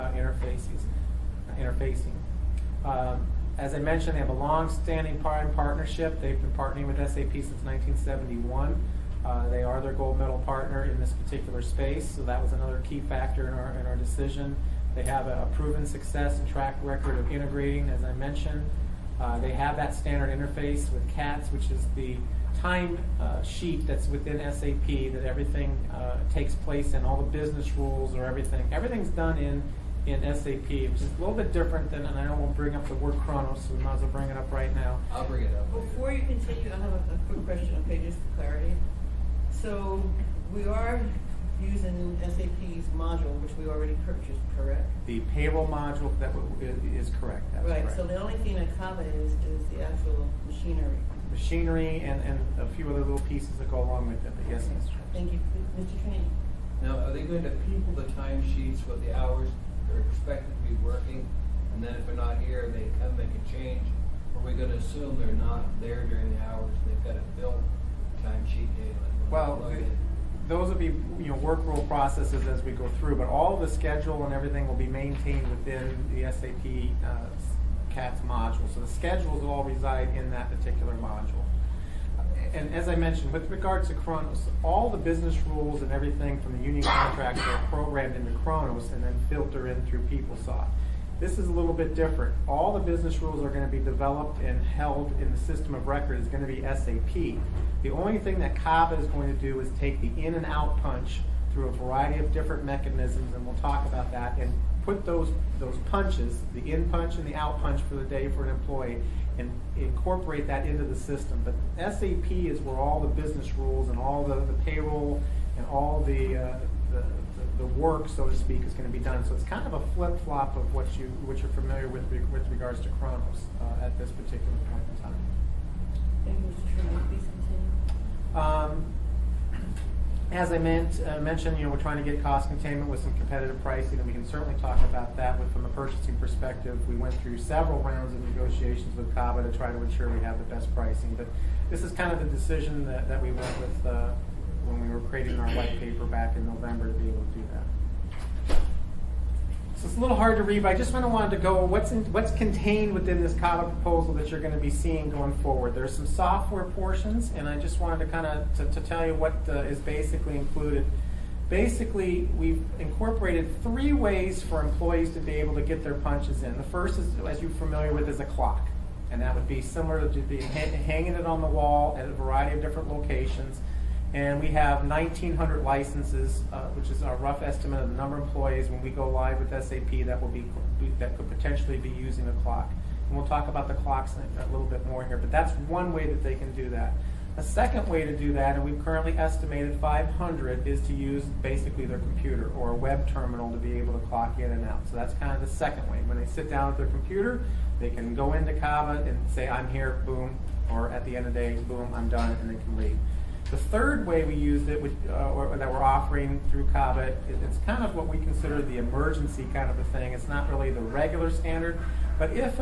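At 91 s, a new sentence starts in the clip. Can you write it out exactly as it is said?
This is a little bit different.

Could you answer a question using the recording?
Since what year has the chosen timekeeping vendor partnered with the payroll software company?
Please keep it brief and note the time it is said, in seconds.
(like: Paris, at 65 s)
1971, at 7 s.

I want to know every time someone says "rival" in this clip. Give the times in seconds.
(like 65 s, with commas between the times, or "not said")
not said.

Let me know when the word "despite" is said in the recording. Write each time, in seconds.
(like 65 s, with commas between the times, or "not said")
not said.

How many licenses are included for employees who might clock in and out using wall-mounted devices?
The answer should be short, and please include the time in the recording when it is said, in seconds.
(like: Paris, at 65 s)
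1,900, at 174 s.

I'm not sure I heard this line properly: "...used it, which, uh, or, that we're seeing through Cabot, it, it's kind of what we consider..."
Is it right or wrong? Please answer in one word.
wrong.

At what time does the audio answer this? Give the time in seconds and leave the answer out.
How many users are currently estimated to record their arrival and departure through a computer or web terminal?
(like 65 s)
189 s.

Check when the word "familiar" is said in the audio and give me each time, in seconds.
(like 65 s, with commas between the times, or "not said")
121 s, 167 s.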